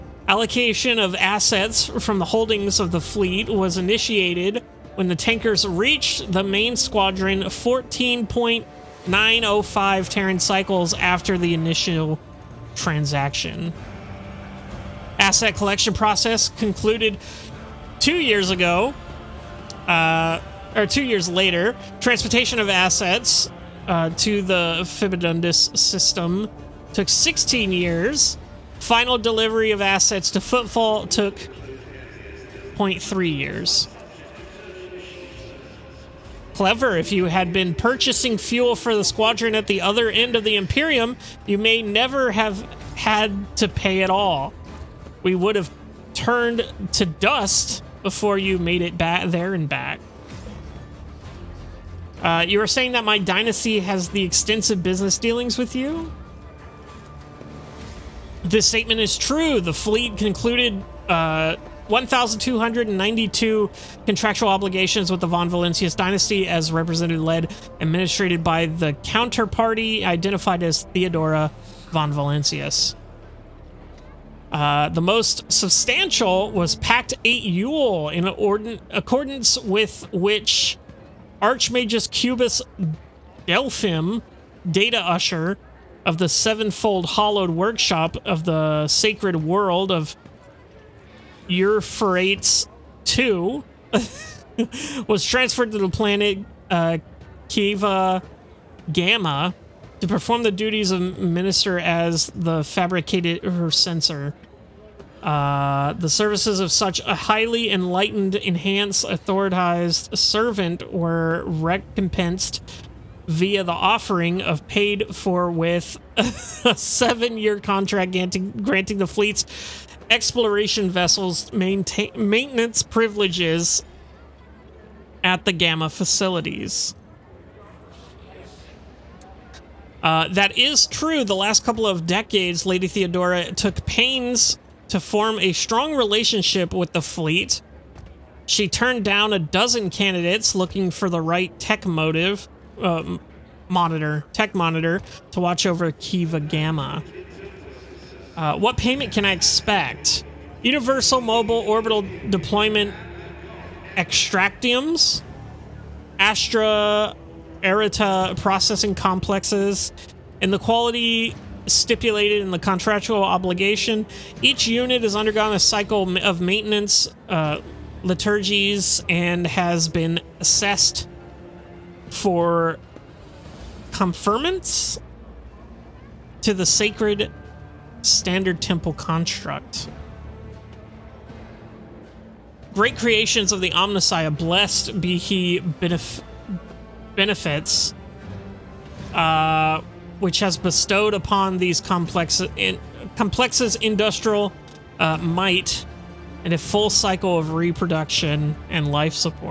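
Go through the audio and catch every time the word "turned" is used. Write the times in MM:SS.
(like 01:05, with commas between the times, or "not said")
00:46, 02:18.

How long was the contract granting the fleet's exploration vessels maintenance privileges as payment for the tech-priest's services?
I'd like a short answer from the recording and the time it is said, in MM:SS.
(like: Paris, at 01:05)
7 years, at 01:56.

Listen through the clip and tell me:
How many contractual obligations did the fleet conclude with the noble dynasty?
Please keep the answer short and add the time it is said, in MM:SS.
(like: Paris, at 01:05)
1,292, at 01:01.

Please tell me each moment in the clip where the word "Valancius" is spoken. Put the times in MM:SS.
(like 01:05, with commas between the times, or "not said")
01:05, 01:12.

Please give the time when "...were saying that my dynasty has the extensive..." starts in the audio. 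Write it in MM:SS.
00:52.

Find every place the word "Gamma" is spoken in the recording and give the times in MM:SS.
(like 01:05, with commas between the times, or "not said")
01:38, 02:05, 02:26.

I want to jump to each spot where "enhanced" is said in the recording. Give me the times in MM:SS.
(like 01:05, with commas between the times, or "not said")
01:48.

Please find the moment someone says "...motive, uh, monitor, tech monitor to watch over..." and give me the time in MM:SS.
02:21.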